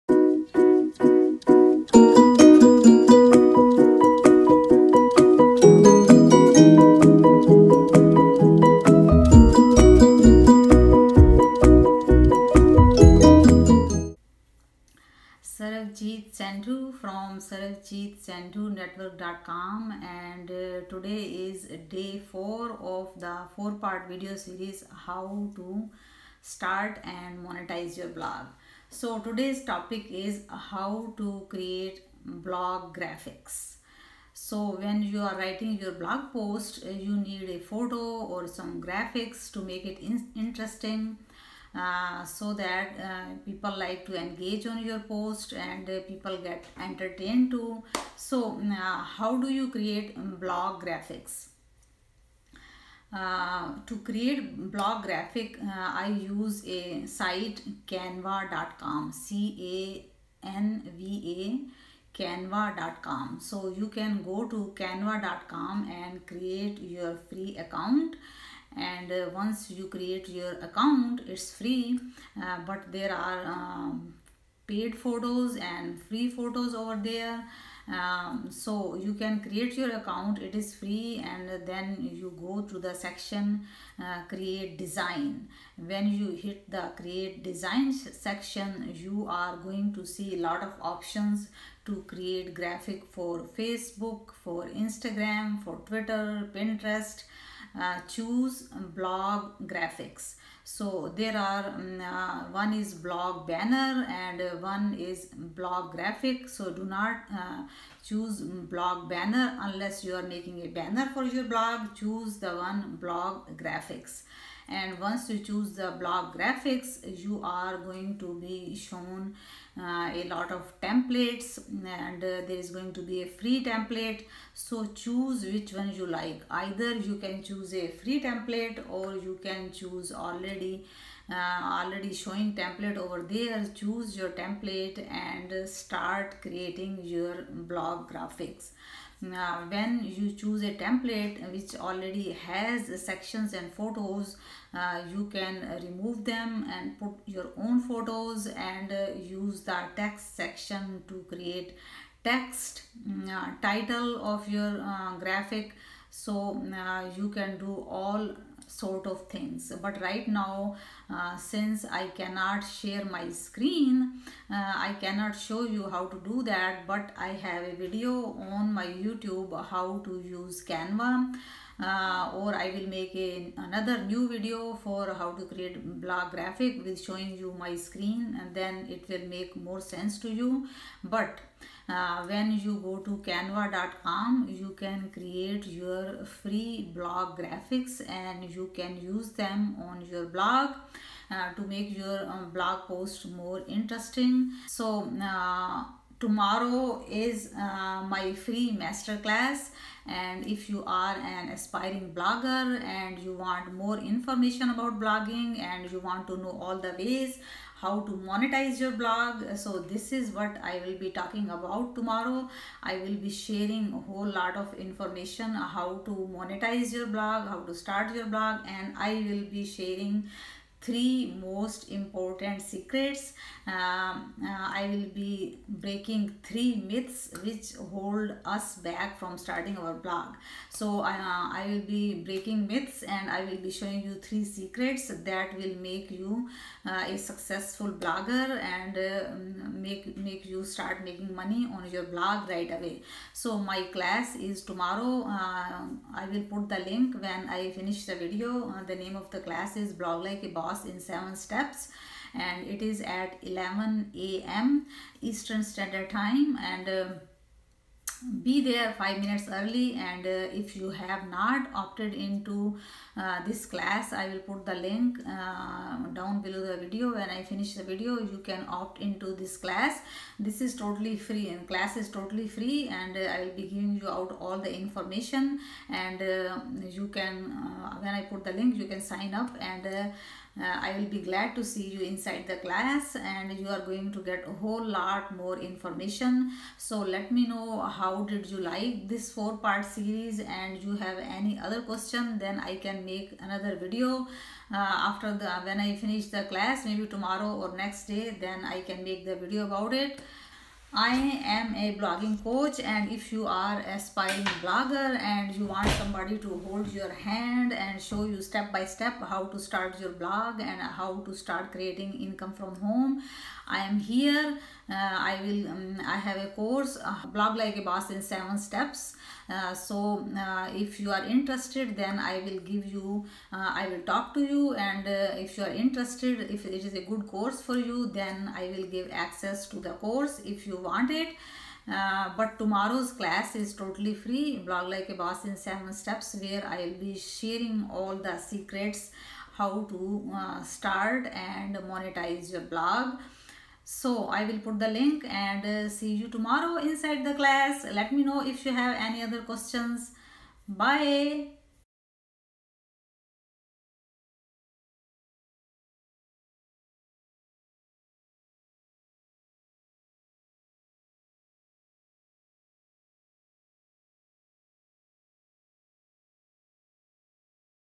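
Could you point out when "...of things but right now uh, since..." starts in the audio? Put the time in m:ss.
2:39.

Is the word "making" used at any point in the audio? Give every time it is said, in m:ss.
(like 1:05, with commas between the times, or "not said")
1:50, 4:01.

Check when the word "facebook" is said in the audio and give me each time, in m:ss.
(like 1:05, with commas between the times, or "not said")
1:33.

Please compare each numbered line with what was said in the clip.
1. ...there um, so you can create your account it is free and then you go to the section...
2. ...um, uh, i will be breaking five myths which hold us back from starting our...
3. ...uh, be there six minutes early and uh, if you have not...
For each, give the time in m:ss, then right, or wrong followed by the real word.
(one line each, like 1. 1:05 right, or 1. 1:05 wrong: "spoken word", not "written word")
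1. 1:17 right
2. 3:43 wrong: "three", not "five"
3. 4:16 wrong: "five", not "six".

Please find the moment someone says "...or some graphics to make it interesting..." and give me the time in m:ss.
0:38.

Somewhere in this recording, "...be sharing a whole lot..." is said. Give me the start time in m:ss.
3:33.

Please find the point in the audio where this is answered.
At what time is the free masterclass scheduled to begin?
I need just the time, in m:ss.
4:13.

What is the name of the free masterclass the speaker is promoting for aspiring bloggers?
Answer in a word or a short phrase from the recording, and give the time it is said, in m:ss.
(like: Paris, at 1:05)
Blog Like a Boss in 7 Steps, at 4:09.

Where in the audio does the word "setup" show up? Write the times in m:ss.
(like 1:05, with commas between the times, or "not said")
not said.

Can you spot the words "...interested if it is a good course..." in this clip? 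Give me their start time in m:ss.
5:25.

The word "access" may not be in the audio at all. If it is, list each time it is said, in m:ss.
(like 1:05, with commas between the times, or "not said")
5:29.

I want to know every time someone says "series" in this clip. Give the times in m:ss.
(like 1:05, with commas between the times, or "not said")
0:24, 4:49.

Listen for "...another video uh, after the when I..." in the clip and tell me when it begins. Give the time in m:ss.
4:53.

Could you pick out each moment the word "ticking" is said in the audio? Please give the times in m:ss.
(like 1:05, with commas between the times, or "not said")
not said.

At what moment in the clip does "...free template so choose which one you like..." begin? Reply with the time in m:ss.
2:03.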